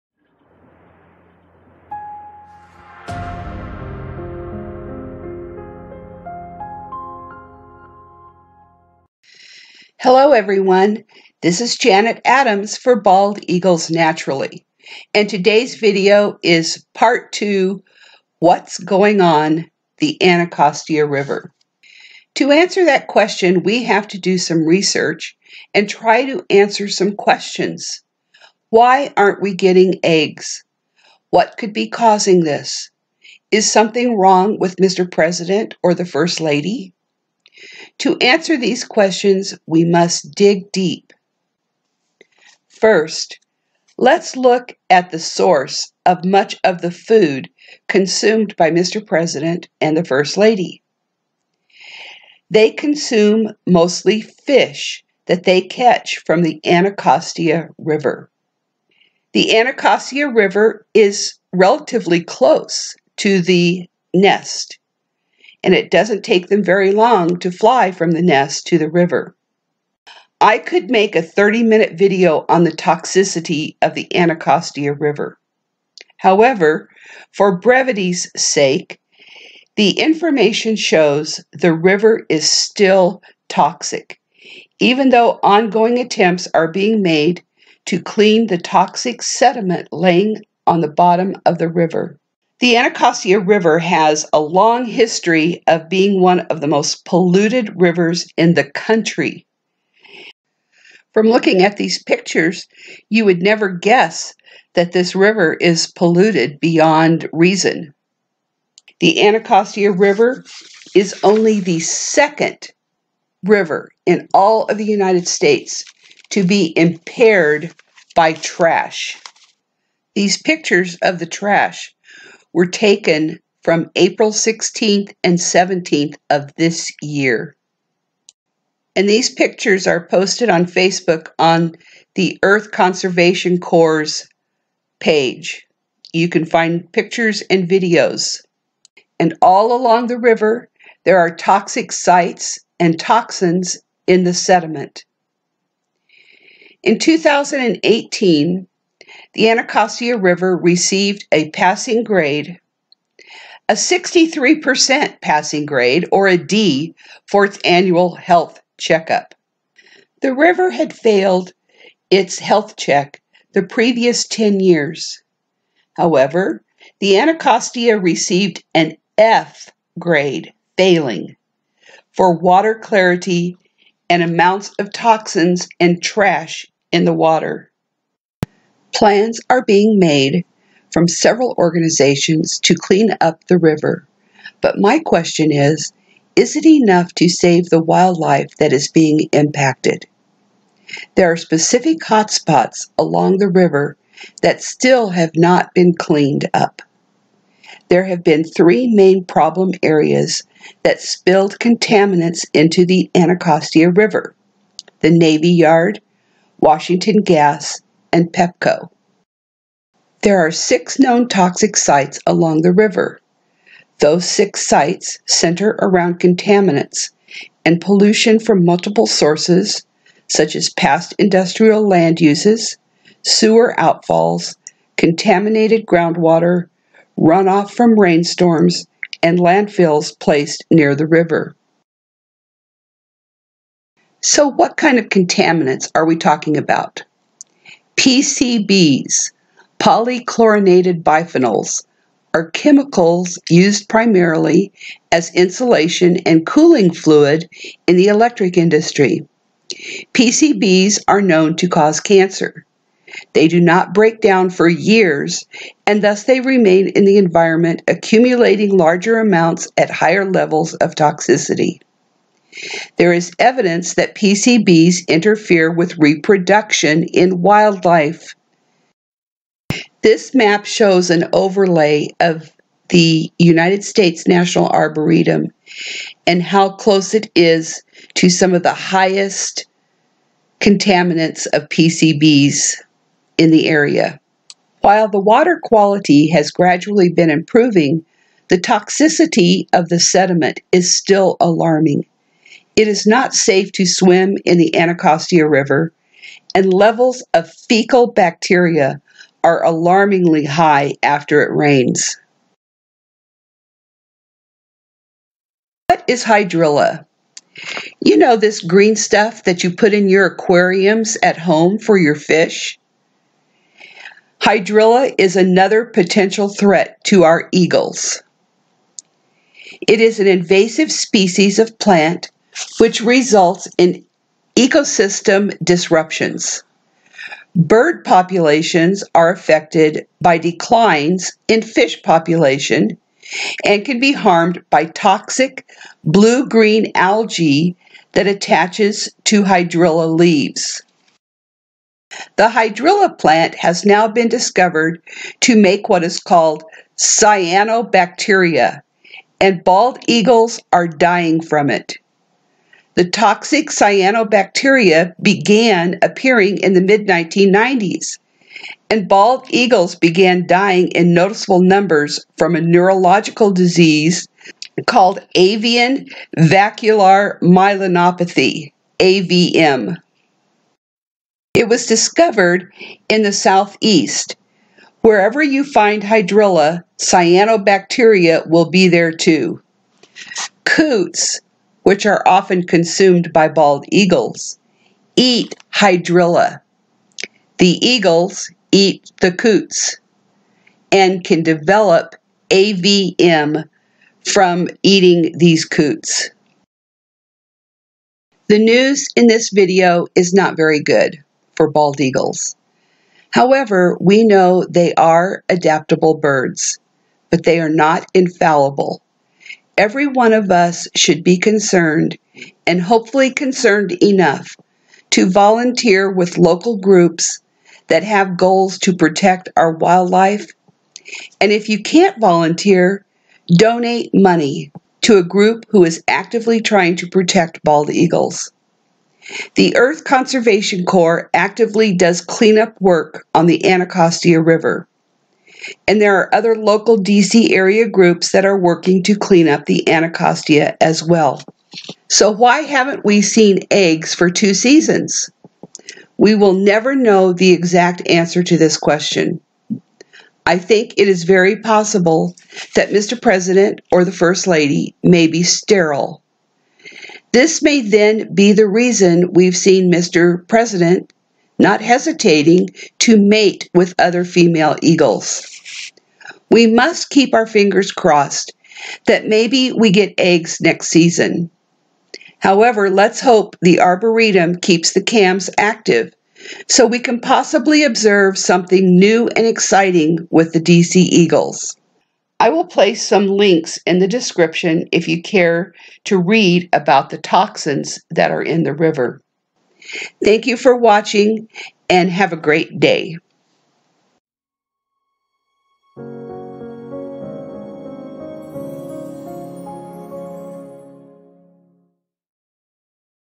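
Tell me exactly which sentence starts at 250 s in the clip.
PCBs are known to cause cancer.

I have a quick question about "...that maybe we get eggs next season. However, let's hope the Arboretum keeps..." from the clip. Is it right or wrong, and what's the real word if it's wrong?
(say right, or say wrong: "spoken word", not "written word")
right.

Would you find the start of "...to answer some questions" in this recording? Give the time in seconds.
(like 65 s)
26 s.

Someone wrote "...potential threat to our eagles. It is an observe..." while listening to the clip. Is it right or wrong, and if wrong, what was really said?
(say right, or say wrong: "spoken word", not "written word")
wrong: "invasive", not "observe".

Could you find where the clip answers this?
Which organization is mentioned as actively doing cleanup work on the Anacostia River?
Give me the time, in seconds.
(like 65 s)
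429 s.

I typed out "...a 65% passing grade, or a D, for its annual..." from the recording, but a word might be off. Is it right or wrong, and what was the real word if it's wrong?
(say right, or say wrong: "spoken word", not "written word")
wrong: "63", not "65".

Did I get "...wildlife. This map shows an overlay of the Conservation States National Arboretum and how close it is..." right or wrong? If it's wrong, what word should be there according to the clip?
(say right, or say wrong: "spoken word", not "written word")
wrong: "United", not "Conservation".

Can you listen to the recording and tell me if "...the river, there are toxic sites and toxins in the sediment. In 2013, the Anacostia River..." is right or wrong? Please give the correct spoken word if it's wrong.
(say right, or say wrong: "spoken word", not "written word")
wrong: "2018", not "2013".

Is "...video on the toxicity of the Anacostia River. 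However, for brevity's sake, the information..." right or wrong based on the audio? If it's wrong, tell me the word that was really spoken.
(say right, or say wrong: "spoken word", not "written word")
right.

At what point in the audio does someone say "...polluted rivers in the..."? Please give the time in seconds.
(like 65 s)
97 s.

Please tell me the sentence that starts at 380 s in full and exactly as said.
Coots which are often consumed by bald eagles, eat hydrilla.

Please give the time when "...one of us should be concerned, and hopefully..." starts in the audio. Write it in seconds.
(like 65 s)
410 s.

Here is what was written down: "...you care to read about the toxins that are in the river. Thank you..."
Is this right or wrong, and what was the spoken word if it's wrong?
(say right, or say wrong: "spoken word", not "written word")
right.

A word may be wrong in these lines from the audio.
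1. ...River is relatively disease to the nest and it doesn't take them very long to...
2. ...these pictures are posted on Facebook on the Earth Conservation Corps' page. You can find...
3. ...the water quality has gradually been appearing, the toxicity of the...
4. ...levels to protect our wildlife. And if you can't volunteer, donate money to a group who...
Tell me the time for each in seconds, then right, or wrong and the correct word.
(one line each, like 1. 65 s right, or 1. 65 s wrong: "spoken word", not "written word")
1. 60 s wrong: "close", not "disease"
2. 129 s right
3. 285 s wrong: "improving", not "appearing"
4. 418 s wrong: "goals", not "levels".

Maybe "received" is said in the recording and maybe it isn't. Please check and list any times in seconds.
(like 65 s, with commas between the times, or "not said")
150 s, 167 s.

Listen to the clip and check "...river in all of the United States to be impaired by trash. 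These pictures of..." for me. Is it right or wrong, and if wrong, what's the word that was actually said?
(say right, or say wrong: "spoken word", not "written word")
right.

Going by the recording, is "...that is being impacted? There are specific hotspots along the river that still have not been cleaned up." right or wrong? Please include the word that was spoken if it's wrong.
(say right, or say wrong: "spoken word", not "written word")
right.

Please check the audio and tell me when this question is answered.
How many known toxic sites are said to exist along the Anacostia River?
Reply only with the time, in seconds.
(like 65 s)
210 s.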